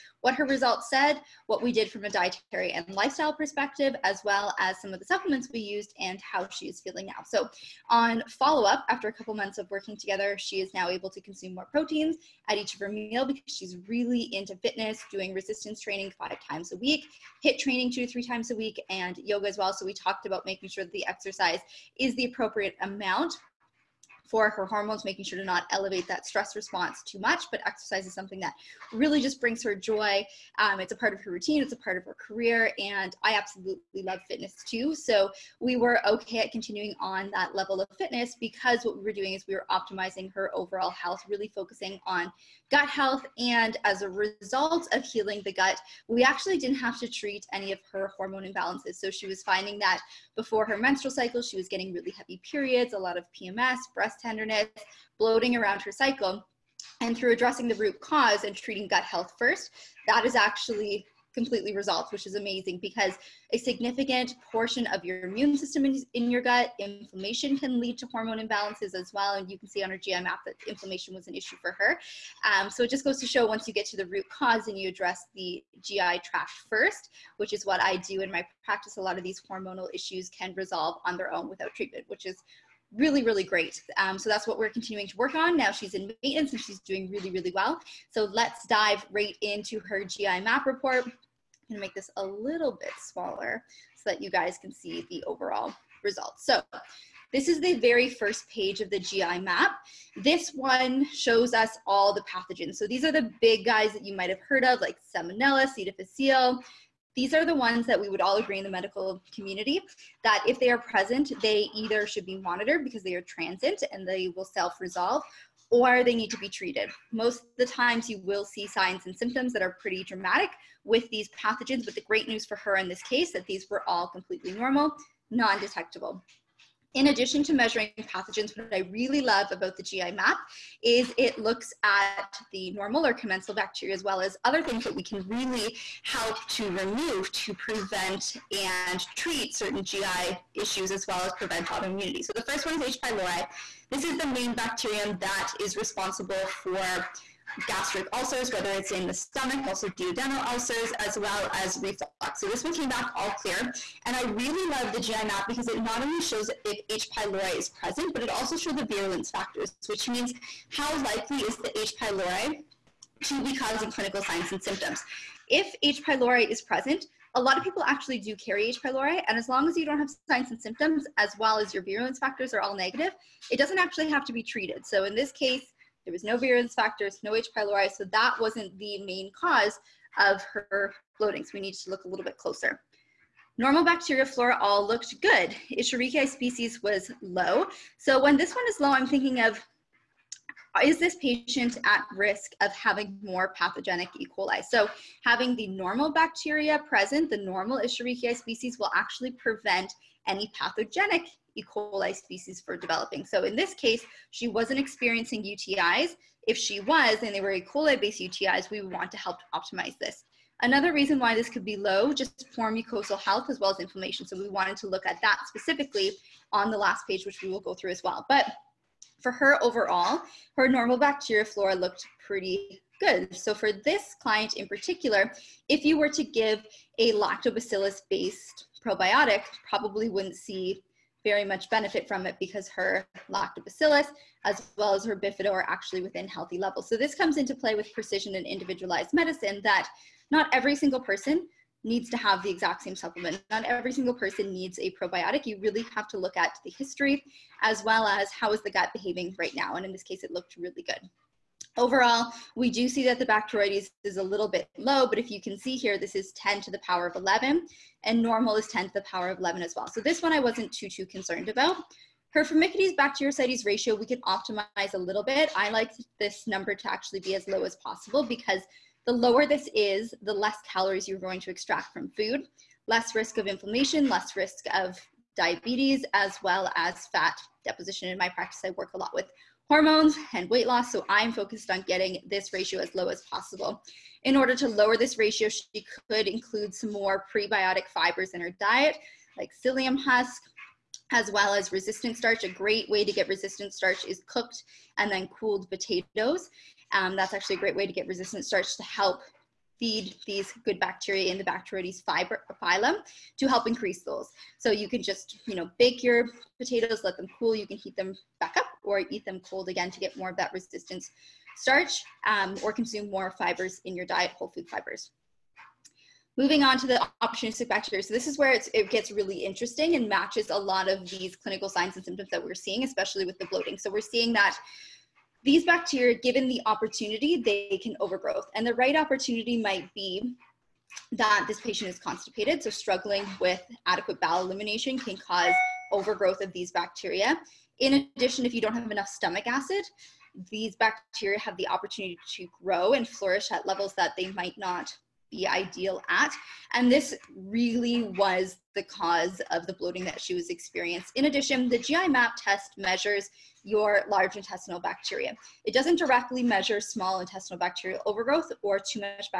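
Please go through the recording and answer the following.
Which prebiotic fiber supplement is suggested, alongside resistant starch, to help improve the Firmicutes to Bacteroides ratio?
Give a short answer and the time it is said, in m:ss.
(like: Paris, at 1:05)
psyllium husk, at 4:49.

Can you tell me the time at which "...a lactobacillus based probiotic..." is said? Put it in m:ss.
3:46.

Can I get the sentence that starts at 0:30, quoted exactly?
Um, it's a part of her routine, it's a part of her career, and I absolutely love fitness too.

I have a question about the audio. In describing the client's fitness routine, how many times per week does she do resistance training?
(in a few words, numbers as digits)
5.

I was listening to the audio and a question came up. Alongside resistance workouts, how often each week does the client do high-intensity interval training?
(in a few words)
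2 to 3 times.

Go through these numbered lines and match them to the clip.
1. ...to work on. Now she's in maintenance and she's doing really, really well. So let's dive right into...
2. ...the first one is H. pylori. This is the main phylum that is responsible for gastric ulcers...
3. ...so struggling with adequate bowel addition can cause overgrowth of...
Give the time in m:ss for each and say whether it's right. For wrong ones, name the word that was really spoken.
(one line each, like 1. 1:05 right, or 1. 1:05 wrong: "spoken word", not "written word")
1. 1:25 right
2. 2:22 wrong: "bacterium", not "phylum"
3. 5:32 wrong: "elimination", not "addition".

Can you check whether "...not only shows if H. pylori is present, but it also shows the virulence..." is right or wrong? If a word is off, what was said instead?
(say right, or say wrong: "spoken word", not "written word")
right.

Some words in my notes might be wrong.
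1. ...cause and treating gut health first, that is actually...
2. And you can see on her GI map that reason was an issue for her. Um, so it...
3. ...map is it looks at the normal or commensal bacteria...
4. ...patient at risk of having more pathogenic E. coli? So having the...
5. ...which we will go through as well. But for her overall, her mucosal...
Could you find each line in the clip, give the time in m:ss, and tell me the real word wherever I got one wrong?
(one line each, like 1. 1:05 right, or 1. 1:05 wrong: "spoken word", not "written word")
1. 0:58 right
2. 1:09 wrong: "inflammation", not "reason"
3. 2:10 right
4. 3:11 right
5. 3:37 wrong: "normal", not "mucosal".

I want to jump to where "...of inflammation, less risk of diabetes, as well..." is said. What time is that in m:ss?
4:33.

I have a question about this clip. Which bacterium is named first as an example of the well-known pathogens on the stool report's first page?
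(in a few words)
Salmonella.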